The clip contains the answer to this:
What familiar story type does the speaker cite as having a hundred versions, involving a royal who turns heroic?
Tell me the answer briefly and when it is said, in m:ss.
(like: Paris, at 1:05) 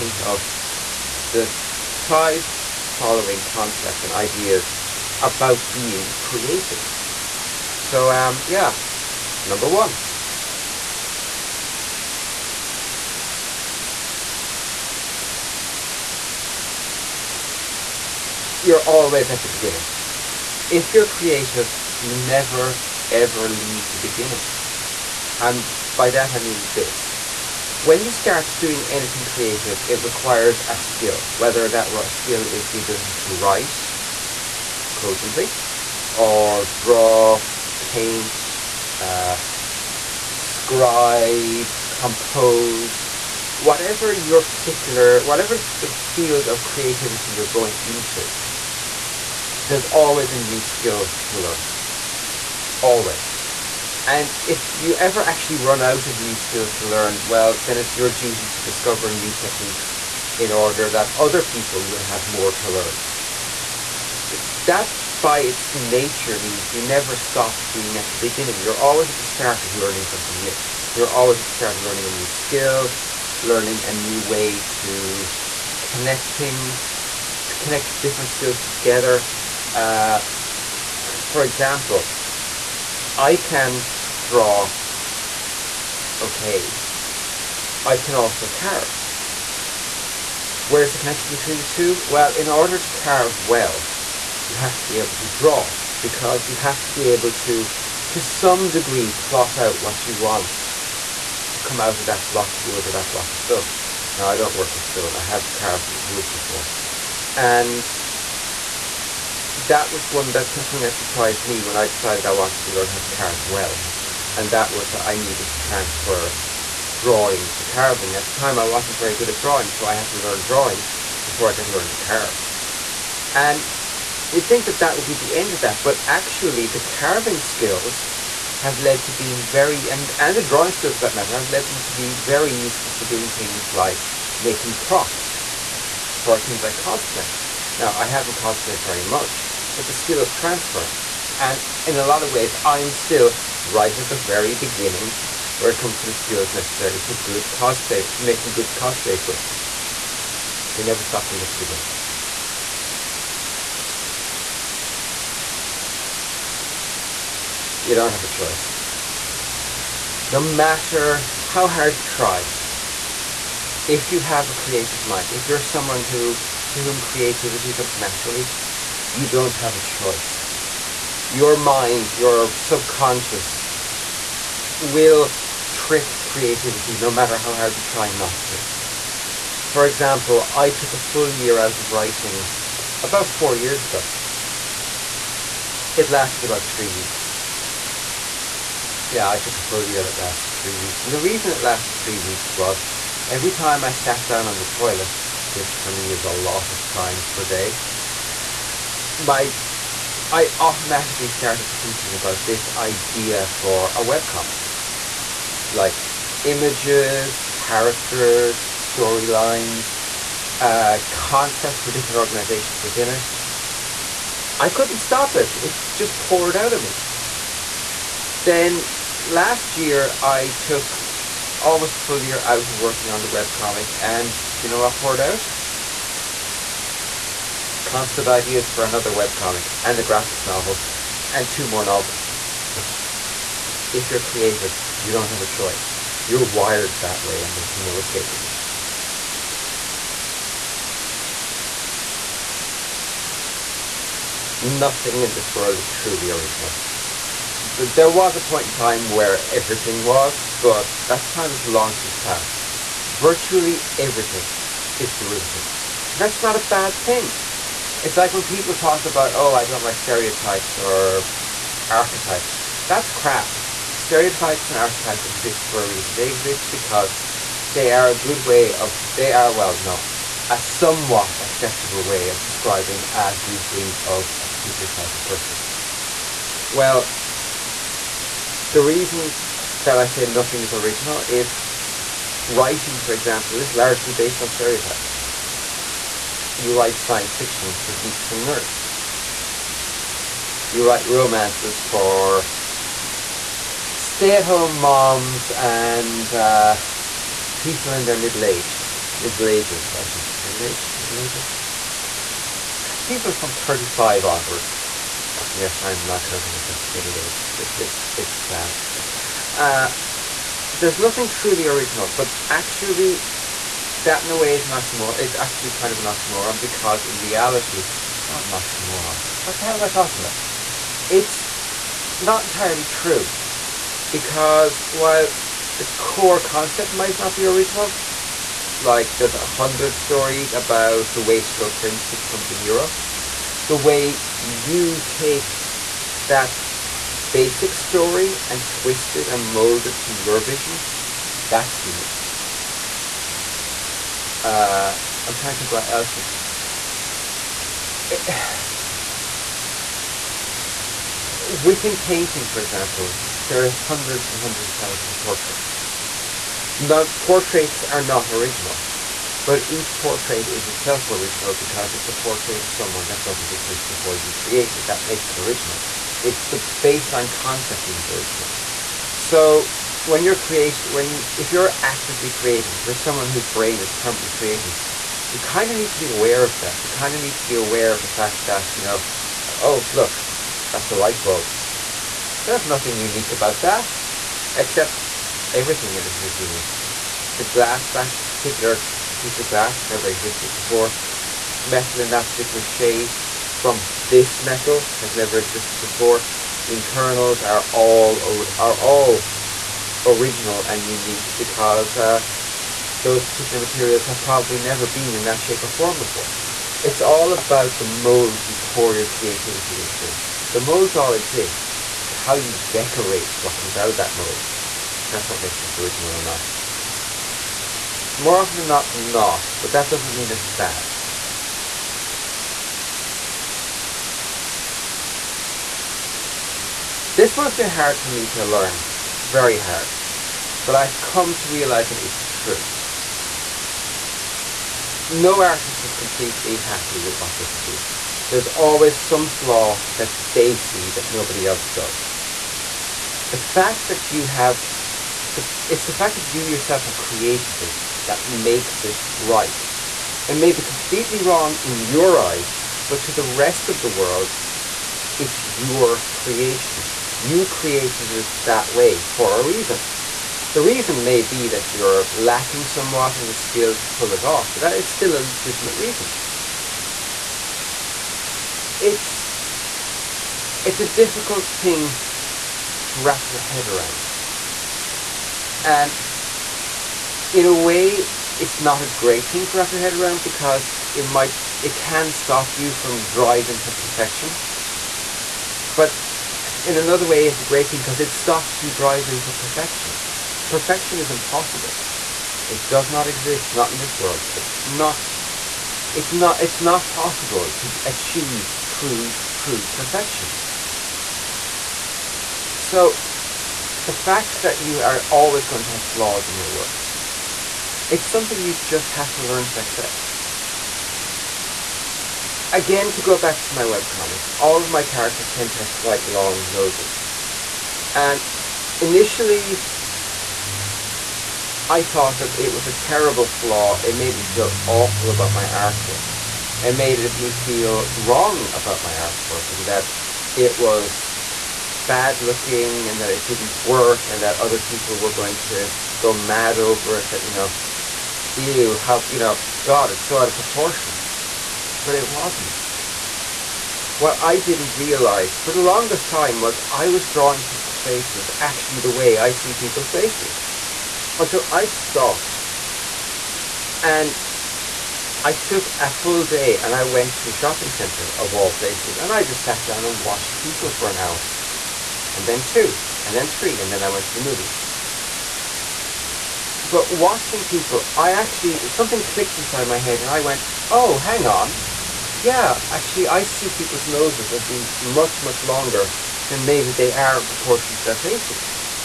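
The wastrel prince, at 5:31.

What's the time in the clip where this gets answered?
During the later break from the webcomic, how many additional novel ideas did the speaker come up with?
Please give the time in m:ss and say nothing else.
3:51.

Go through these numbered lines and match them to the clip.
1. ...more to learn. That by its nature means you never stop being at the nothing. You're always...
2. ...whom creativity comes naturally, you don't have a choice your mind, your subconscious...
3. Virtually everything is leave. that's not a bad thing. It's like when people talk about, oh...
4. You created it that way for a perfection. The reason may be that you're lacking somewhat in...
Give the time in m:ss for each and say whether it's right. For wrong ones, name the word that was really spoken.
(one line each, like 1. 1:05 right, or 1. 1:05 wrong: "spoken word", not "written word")
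1. 1:02 wrong: "beginning", not "nothing"
2. 2:46 right
3. 4:13 wrong: "derivative", not "leave"
4. 7:37 wrong: "reason", not "perfection".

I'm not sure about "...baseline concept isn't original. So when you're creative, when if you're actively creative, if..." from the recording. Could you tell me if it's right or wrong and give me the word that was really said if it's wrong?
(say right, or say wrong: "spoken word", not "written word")
right.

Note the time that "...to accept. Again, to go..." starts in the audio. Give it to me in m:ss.
8:29.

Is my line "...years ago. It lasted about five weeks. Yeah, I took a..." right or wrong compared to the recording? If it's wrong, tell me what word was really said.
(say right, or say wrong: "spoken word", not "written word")
wrong: "three", not "five".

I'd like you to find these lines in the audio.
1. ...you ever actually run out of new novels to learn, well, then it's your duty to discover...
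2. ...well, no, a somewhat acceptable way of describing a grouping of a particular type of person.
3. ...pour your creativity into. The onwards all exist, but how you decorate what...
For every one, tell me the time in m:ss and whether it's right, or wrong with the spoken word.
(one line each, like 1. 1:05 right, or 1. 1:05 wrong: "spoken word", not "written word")
1. 0:54 wrong: "skills", not "novels"
2. 4:29 right
3. 6:48 wrong: "molds", not "onwards".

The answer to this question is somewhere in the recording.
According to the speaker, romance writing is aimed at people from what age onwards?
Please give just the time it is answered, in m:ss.
5:03.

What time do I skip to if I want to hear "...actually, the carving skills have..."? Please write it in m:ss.
2:06.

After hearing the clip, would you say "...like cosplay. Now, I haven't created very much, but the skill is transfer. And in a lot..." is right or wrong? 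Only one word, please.
wrong.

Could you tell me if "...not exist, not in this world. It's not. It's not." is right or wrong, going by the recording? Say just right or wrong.
right.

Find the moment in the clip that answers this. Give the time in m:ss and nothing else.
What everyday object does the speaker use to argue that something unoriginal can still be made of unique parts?
6:20.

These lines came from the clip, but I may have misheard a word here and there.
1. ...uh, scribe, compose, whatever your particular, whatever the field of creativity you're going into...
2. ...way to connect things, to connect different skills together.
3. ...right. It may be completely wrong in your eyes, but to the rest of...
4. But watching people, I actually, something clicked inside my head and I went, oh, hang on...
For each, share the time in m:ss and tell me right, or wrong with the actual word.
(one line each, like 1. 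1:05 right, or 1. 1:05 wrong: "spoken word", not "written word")
1. 0:38 right
2. 1:14 right
3. 7:29 right
4. 9:26 right.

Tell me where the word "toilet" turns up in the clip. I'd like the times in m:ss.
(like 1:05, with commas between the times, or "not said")
3:14.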